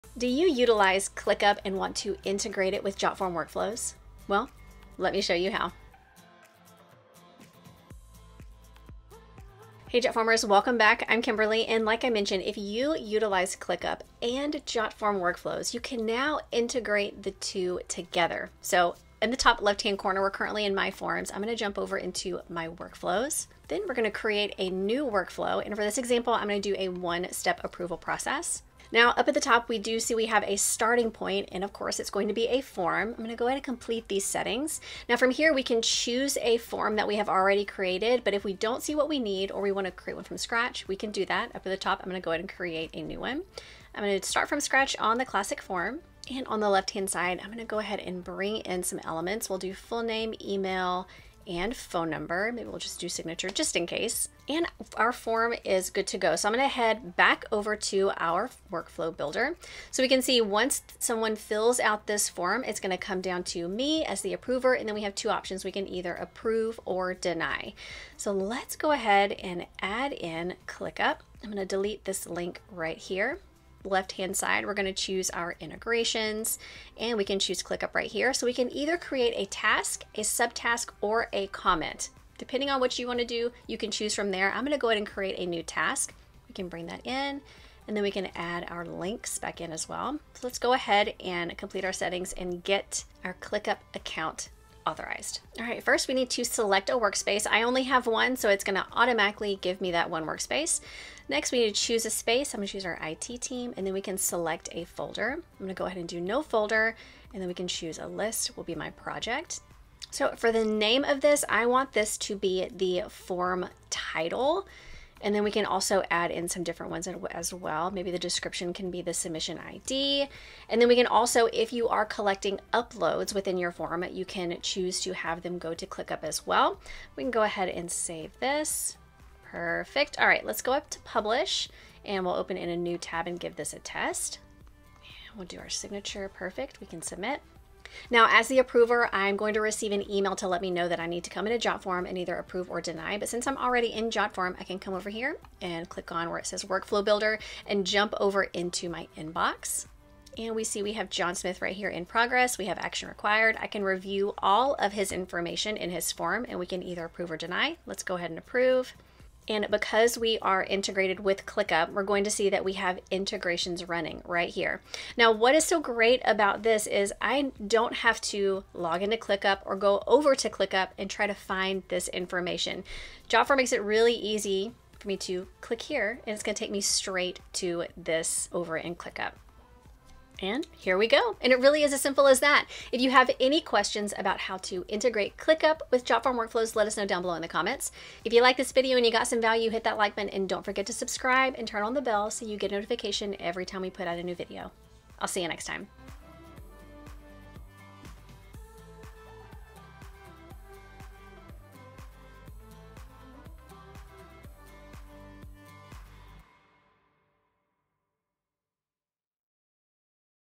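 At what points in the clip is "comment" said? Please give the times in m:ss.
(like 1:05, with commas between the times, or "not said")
1:21, 3:07.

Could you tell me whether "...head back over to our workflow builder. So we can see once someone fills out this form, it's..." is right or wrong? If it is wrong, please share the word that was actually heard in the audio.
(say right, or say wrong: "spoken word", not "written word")
right.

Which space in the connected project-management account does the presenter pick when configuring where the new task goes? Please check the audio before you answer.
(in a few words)
IT team.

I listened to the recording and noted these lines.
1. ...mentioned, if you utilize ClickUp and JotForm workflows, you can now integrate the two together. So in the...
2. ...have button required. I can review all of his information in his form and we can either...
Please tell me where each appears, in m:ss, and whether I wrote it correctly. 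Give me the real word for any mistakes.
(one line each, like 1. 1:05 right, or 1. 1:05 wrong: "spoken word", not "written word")
1. 0:12 right
2. 2:32 wrong: "action", not "button".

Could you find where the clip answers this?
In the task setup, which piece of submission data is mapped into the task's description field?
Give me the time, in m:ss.
1:59.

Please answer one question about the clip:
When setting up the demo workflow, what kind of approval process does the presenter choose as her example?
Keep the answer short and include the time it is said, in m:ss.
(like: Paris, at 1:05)
One-step approval, at 0:26.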